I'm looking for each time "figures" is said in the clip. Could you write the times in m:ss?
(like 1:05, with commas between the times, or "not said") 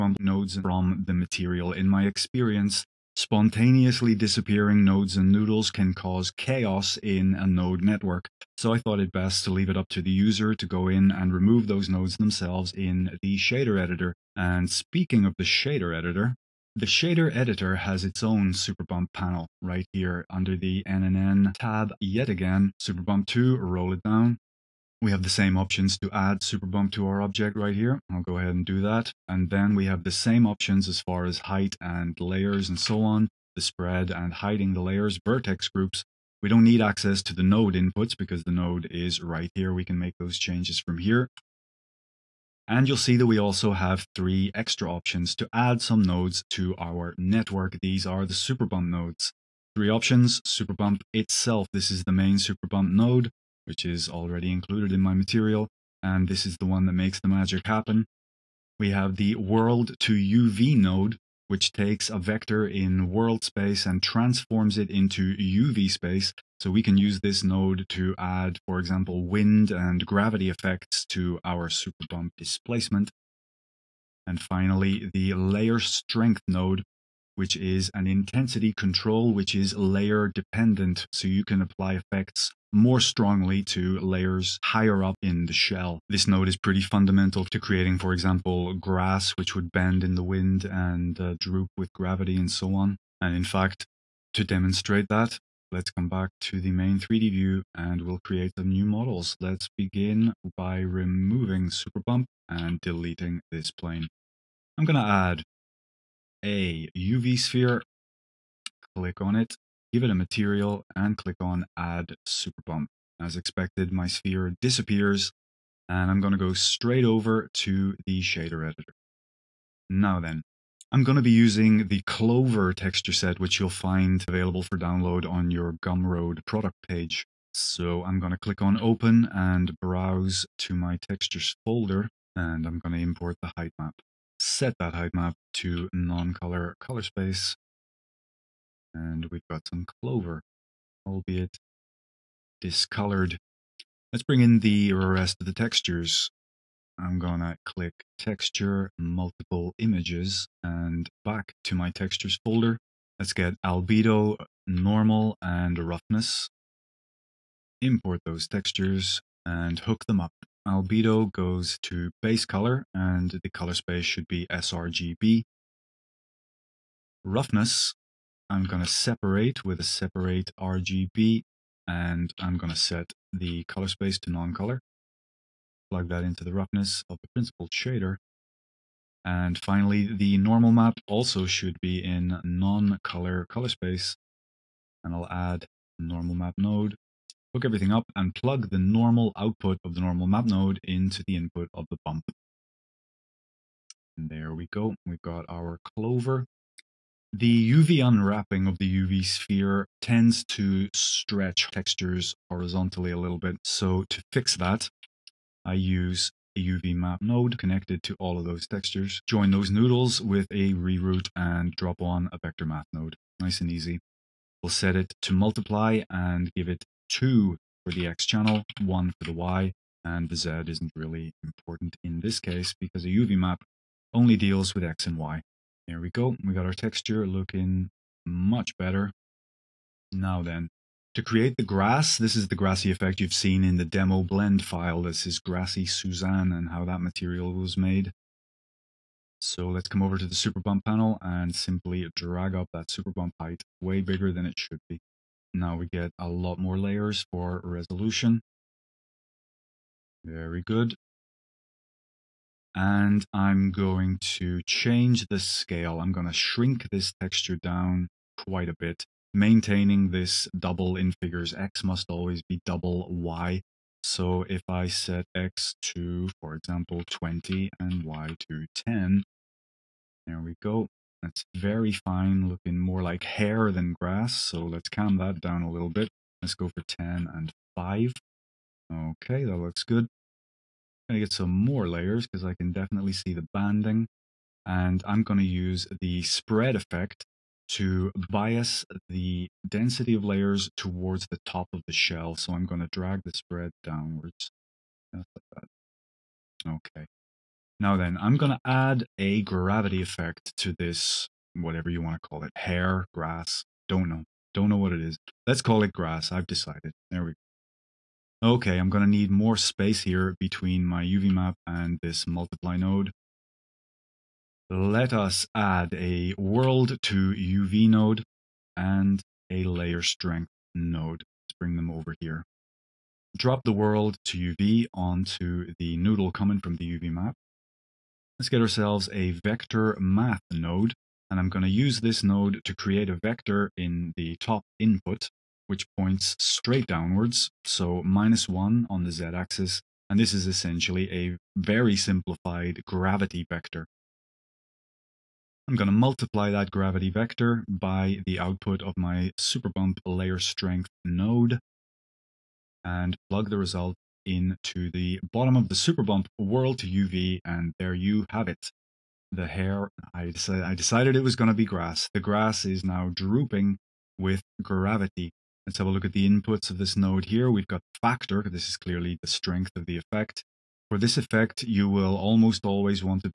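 4:21.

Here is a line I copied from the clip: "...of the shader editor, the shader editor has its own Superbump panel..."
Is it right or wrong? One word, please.
right.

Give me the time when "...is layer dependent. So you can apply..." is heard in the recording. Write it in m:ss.
1:19.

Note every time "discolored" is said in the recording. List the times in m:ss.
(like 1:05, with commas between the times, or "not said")
2:22.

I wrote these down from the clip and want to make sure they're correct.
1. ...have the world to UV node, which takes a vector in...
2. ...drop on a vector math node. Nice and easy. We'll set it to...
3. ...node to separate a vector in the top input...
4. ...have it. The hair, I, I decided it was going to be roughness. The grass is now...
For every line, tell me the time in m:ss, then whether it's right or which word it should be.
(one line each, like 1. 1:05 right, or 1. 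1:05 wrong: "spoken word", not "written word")
1. 0:58 right
2. 3:31 right
3. 5:32 wrong: "create", not "separate"
4. 5:58 wrong: "grass", not "roughness".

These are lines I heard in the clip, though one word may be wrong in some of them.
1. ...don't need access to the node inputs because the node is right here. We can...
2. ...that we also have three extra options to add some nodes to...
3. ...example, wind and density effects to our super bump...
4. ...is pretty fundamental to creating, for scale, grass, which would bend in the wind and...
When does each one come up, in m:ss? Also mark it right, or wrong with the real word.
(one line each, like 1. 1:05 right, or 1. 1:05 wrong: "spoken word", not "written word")
1. 0:36 right
2. 0:43 right
3. 1:08 wrong: "gravity", not "density"
4. 1:26 wrong: "example", not "scale".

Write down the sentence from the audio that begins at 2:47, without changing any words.
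Roughness I'm going to separate with a separate RGB and I'm going to set the color space to non-color.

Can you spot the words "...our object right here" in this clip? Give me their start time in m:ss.
0:27.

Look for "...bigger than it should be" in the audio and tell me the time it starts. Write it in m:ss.
4:04.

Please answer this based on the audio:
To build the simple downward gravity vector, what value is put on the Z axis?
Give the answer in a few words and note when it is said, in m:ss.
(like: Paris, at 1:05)
-1, at 5:38.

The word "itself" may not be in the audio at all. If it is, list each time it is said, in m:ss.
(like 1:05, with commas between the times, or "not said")
0:51.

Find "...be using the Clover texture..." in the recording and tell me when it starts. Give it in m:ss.
2:01.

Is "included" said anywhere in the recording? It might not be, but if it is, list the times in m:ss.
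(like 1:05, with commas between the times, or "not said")
0:54.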